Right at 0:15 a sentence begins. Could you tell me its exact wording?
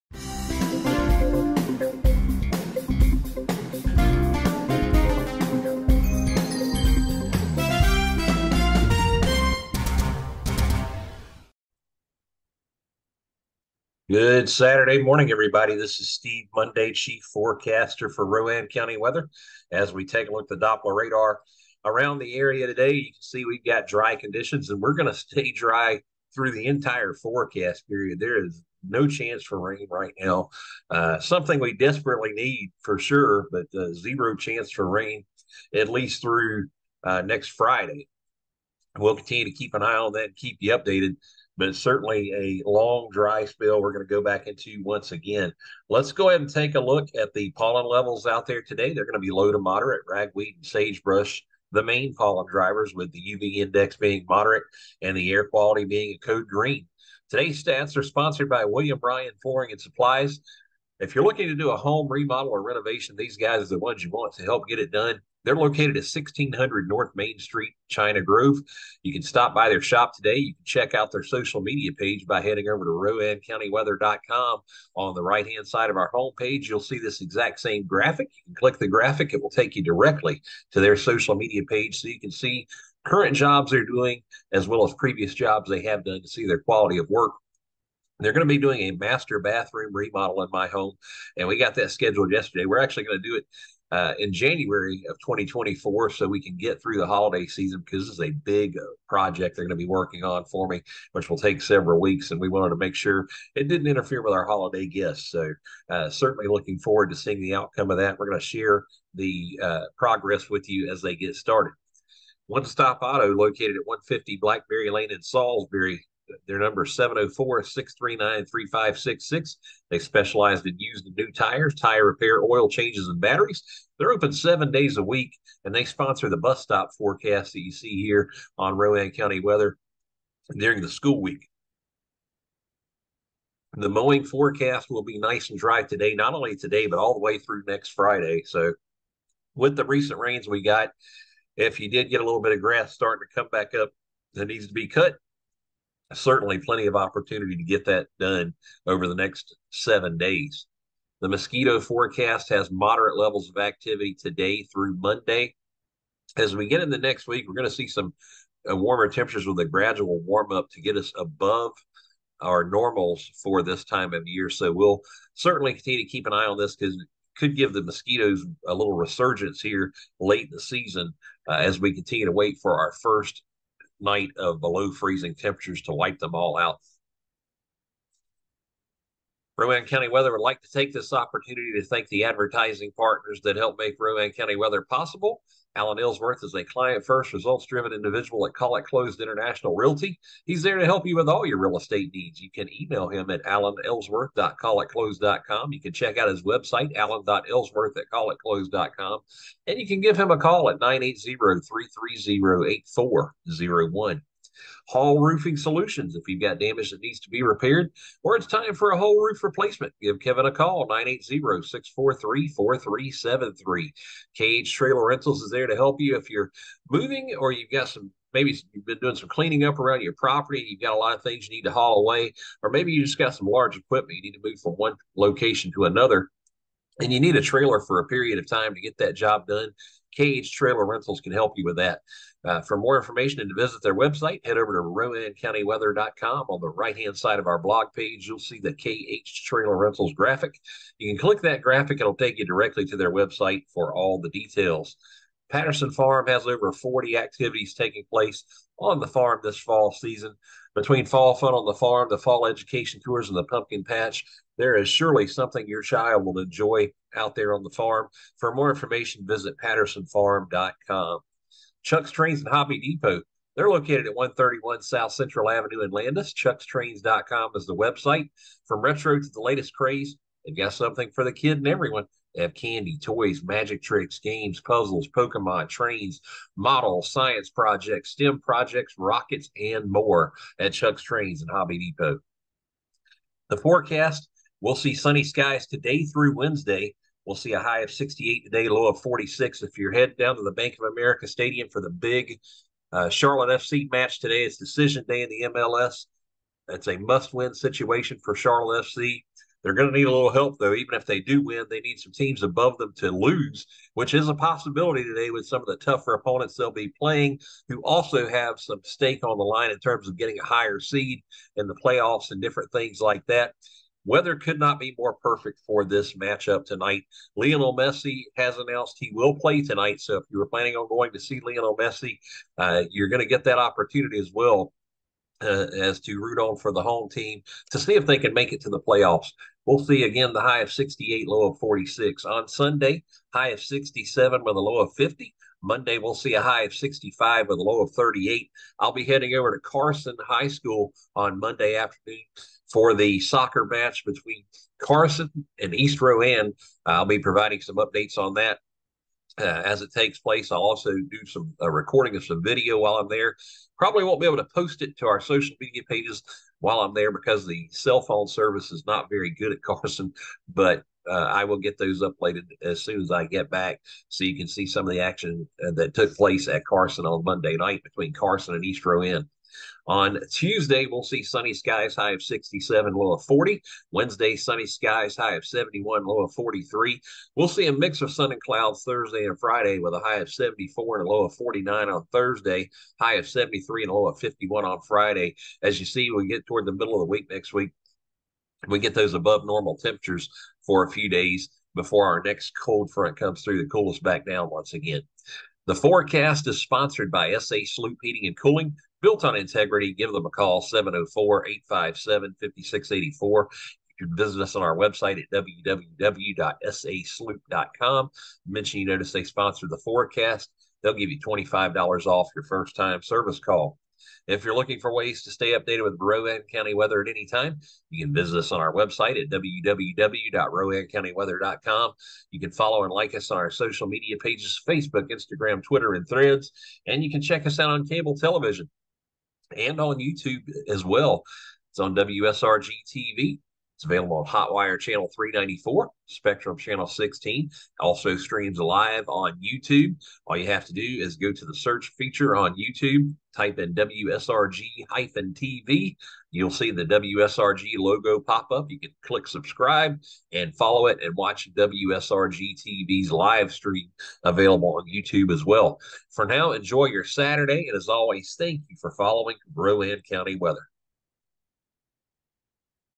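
This is Steve Monday, Chief Forecaster for Rowan County Weather.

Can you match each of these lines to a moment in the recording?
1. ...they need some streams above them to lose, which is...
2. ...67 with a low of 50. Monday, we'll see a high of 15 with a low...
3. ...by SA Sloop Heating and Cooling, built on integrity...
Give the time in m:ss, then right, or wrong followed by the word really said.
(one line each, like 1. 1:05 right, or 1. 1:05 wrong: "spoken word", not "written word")
1. 5:01 wrong: "teams", not "streams"
2. 5:33 wrong: "65", not "15"
3. 6:37 right.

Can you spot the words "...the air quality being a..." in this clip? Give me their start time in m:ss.
0:55.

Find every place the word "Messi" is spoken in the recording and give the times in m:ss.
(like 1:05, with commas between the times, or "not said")
5:17, 5:21.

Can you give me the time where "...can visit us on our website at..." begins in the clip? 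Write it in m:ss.
6:58.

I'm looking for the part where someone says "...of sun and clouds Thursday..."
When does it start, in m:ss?
6:18.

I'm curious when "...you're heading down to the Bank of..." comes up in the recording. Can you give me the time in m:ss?
4:49.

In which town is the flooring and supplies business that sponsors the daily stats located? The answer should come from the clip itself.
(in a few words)
China Grove.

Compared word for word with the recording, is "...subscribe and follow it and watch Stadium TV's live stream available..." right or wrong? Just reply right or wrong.
wrong.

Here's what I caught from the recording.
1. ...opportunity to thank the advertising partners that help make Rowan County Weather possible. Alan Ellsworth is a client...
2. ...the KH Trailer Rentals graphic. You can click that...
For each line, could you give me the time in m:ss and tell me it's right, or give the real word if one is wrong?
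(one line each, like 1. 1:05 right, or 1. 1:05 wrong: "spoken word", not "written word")
1. 3:01 right
2. 3:58 right.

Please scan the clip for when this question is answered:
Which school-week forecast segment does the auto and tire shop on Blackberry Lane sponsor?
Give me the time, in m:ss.
2:06.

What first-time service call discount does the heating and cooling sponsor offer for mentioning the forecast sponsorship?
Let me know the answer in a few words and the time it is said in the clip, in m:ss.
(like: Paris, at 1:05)
$25 off, at 6:51.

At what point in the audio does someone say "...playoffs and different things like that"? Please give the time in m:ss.
5:11.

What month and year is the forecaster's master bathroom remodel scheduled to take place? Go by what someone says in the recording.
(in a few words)
January 2024.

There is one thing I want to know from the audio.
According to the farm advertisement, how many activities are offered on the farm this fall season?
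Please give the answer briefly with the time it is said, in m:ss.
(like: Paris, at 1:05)
Over 40, at 4:06.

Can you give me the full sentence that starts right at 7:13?
It's available on Hotwire Channel 394, Spectrum Channel 16.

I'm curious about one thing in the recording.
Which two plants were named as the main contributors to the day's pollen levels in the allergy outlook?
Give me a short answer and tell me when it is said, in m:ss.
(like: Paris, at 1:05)
Ragweed and sagebrush, at 0:50.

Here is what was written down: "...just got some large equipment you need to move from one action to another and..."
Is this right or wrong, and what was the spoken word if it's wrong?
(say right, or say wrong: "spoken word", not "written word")
wrong: "location", not "action".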